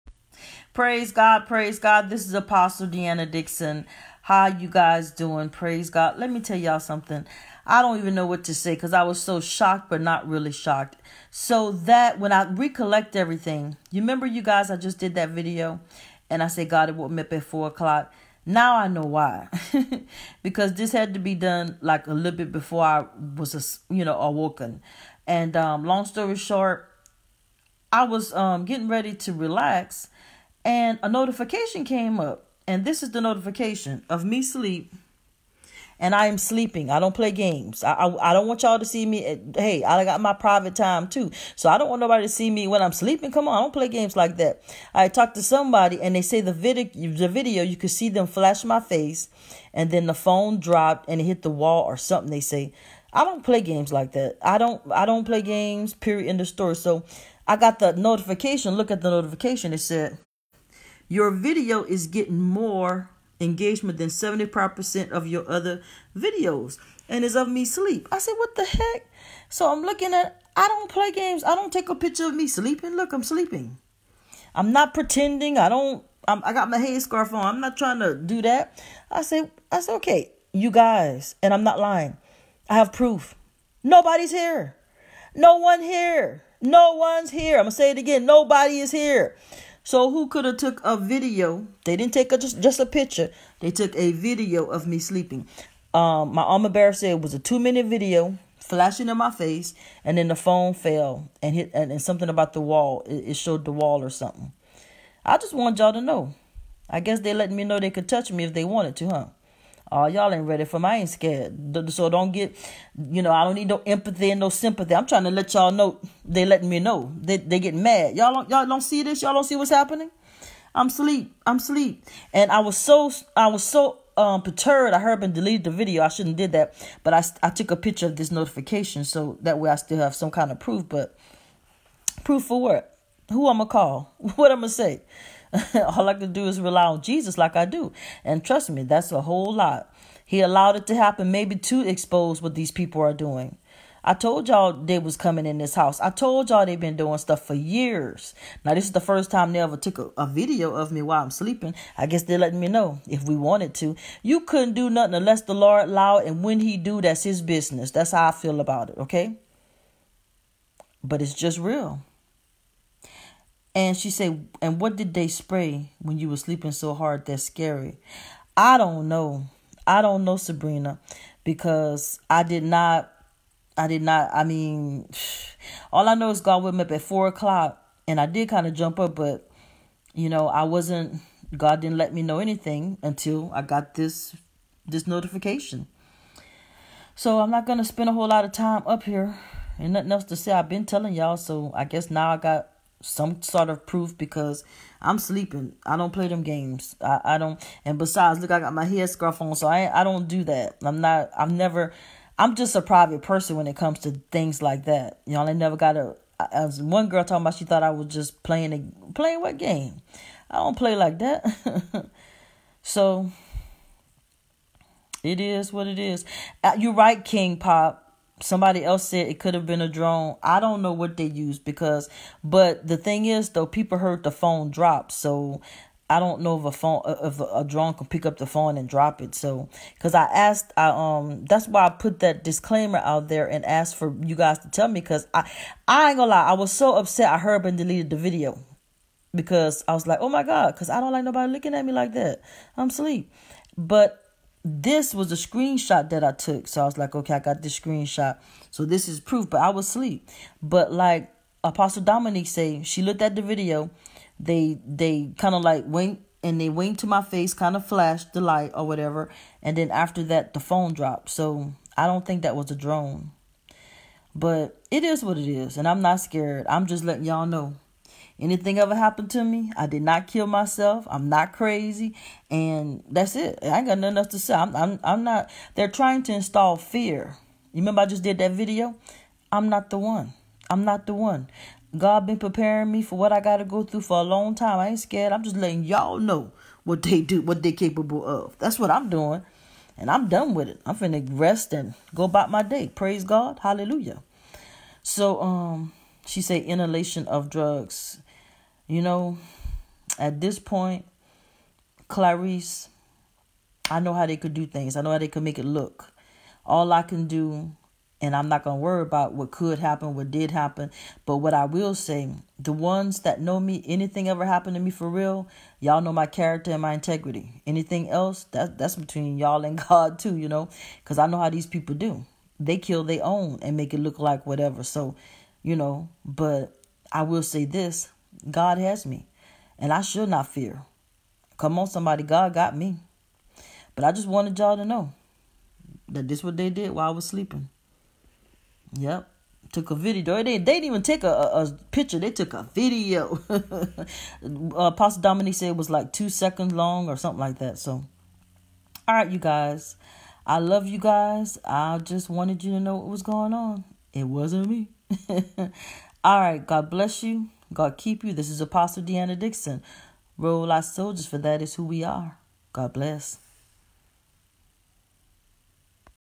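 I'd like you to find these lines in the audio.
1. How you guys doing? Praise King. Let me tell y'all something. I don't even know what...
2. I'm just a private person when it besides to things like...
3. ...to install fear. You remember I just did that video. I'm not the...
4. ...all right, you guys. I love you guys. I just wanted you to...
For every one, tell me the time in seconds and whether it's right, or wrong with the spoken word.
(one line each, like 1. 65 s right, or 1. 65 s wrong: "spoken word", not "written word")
1. 4 s wrong: "God", not "King"
2. 202 s wrong: "comes", not "besides"
3. 276 s right
4. 349 s right.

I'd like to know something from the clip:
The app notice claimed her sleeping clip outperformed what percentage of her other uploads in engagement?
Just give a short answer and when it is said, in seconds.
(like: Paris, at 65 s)
75%, at 64 s.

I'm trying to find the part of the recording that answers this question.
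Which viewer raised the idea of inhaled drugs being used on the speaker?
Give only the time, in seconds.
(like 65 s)
302 s.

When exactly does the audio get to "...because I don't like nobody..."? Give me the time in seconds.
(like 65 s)
240 s.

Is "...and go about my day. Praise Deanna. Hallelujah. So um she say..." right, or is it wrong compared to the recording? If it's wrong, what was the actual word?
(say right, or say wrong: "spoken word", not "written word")
wrong: "God", not "Deanna".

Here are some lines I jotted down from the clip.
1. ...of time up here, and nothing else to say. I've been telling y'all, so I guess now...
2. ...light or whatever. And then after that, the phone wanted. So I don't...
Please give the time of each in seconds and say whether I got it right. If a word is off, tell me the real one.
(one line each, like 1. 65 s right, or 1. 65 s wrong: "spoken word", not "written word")
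1. 188 s right
2. 258 s wrong: "dropped", not "wanted".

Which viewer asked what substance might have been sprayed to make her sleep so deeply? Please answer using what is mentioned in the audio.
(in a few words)
Sabrina.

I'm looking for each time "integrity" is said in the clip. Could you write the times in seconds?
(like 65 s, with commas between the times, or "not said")
316 s.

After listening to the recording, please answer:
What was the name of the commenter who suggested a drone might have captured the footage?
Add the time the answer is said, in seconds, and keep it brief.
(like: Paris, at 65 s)
King Pop, at 217 s.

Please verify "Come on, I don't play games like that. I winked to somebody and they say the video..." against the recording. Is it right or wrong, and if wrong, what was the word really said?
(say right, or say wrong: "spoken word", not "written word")
wrong: "talked", not "winked".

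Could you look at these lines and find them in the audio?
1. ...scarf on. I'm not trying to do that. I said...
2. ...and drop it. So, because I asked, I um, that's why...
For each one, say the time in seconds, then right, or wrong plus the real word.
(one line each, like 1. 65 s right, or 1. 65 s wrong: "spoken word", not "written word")
1. 77 s right
2. 228 s right.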